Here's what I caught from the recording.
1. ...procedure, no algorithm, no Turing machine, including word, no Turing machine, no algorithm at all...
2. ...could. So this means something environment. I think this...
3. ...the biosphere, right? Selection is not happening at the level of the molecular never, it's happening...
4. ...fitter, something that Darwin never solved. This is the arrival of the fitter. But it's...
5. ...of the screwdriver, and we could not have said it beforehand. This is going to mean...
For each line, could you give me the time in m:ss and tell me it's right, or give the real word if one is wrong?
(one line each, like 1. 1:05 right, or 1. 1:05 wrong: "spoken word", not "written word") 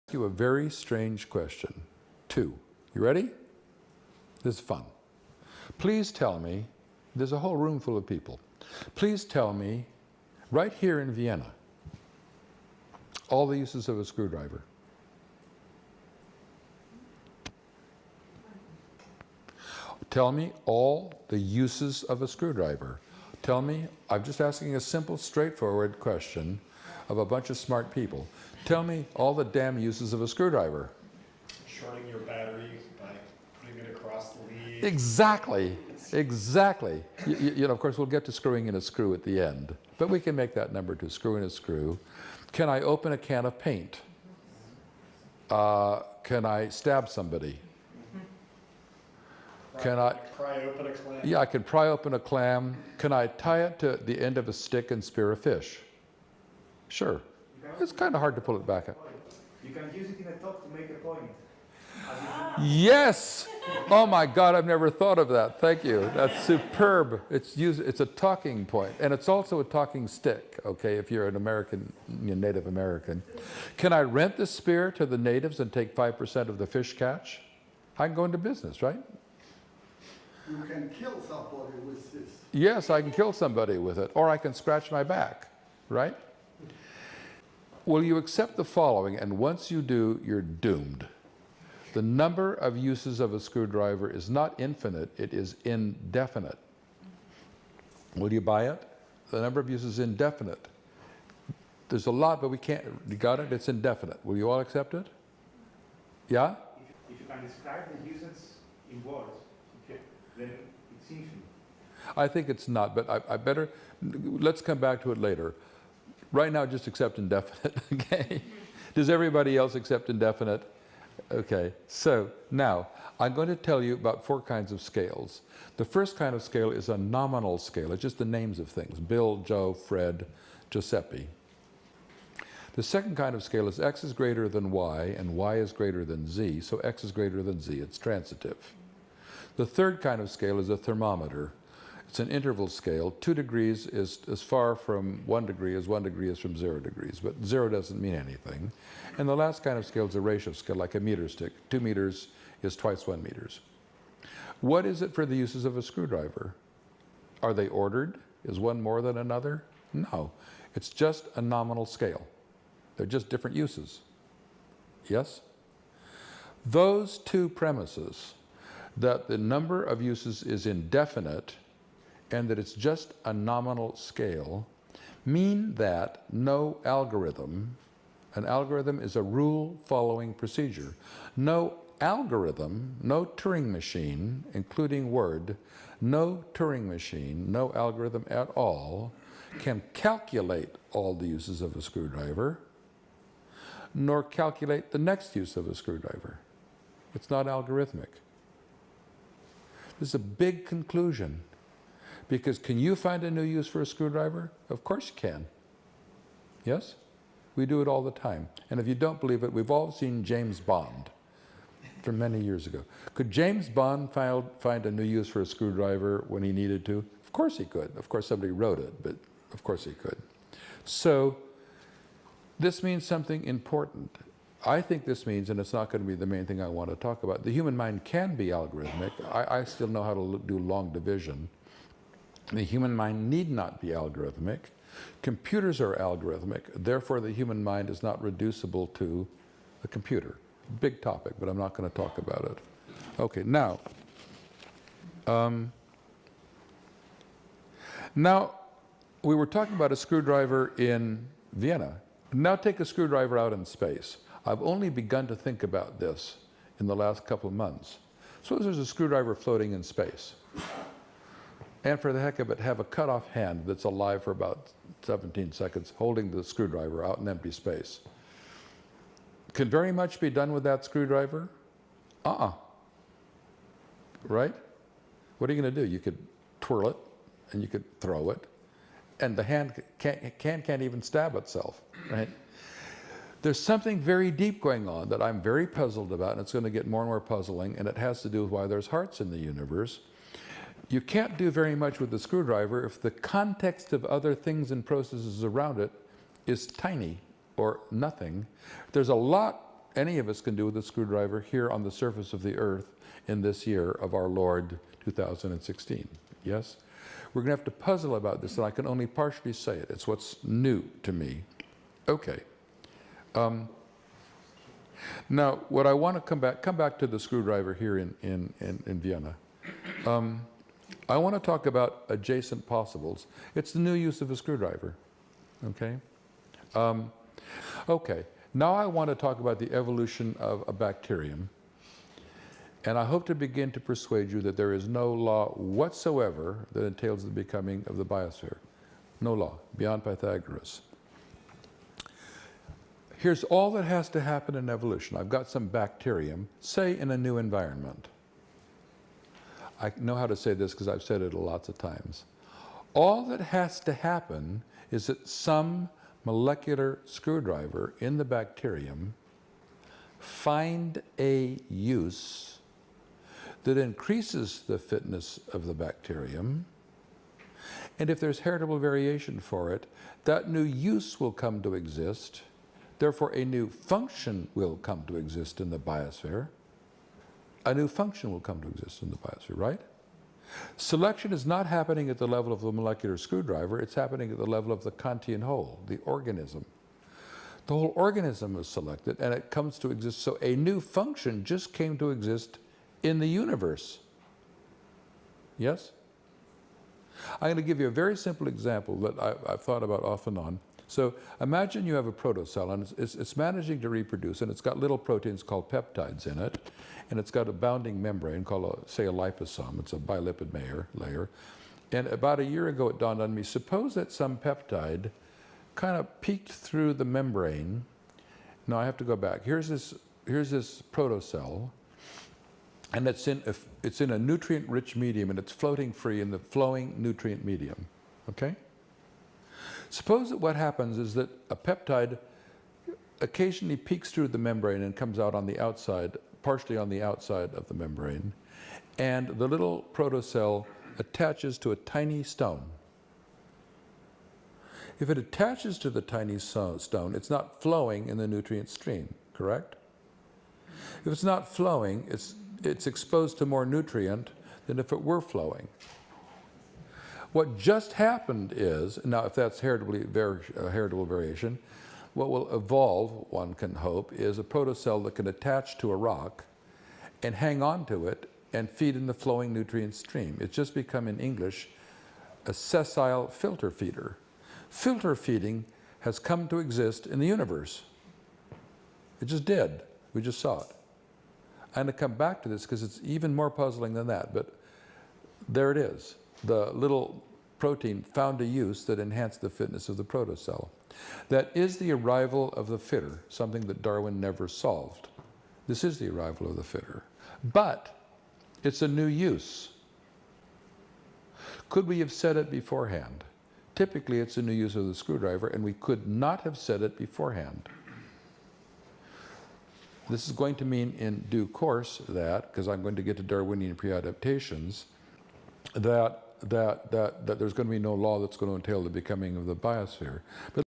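1. 3:00 right
2. 3:39 wrong: "important", not "environment"
3. 6:19 wrong: "screwdriver", not "never"
4. 8:12 right
5. 8:24 right.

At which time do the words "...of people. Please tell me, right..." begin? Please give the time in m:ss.
0:07.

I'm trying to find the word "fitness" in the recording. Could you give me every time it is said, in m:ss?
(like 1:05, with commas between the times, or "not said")
6:04, 8:09.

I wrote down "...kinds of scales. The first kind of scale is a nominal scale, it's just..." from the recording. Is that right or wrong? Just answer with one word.
right.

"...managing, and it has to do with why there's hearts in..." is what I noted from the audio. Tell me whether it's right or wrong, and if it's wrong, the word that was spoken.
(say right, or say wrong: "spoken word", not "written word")
wrong: "puzzling", not "managing".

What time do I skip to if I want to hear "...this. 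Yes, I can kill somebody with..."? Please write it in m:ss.
1:22.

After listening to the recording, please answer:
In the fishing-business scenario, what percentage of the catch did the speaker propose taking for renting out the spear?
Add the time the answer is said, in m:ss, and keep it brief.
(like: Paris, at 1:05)
5%, at 1:15.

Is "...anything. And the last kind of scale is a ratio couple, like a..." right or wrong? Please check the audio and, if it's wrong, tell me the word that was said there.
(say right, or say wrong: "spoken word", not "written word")
wrong: "scale", not "couple".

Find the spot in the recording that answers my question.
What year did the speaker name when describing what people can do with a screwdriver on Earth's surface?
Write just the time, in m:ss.
5:05.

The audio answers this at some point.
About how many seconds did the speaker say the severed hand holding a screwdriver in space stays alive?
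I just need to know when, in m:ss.
4:25.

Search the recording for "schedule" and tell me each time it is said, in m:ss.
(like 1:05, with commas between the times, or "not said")
not said.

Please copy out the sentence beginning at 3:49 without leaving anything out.
I, I still know how to do long division.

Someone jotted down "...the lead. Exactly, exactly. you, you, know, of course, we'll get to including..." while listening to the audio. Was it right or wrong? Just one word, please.
wrong.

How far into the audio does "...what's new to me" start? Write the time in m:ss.
5:10.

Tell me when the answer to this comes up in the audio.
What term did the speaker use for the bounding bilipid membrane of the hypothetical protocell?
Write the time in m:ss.
6:49.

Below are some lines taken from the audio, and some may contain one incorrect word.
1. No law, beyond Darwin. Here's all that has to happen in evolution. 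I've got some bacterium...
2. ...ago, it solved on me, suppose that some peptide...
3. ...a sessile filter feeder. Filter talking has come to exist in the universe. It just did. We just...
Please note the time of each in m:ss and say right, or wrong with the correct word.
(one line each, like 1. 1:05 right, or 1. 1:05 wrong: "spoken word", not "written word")
1. 5:39 wrong: "Pythagoras", not "Darwin"
2. 6:52 wrong: "dawned", not "solved"
3. 7:52 wrong: "feeding", not "talking".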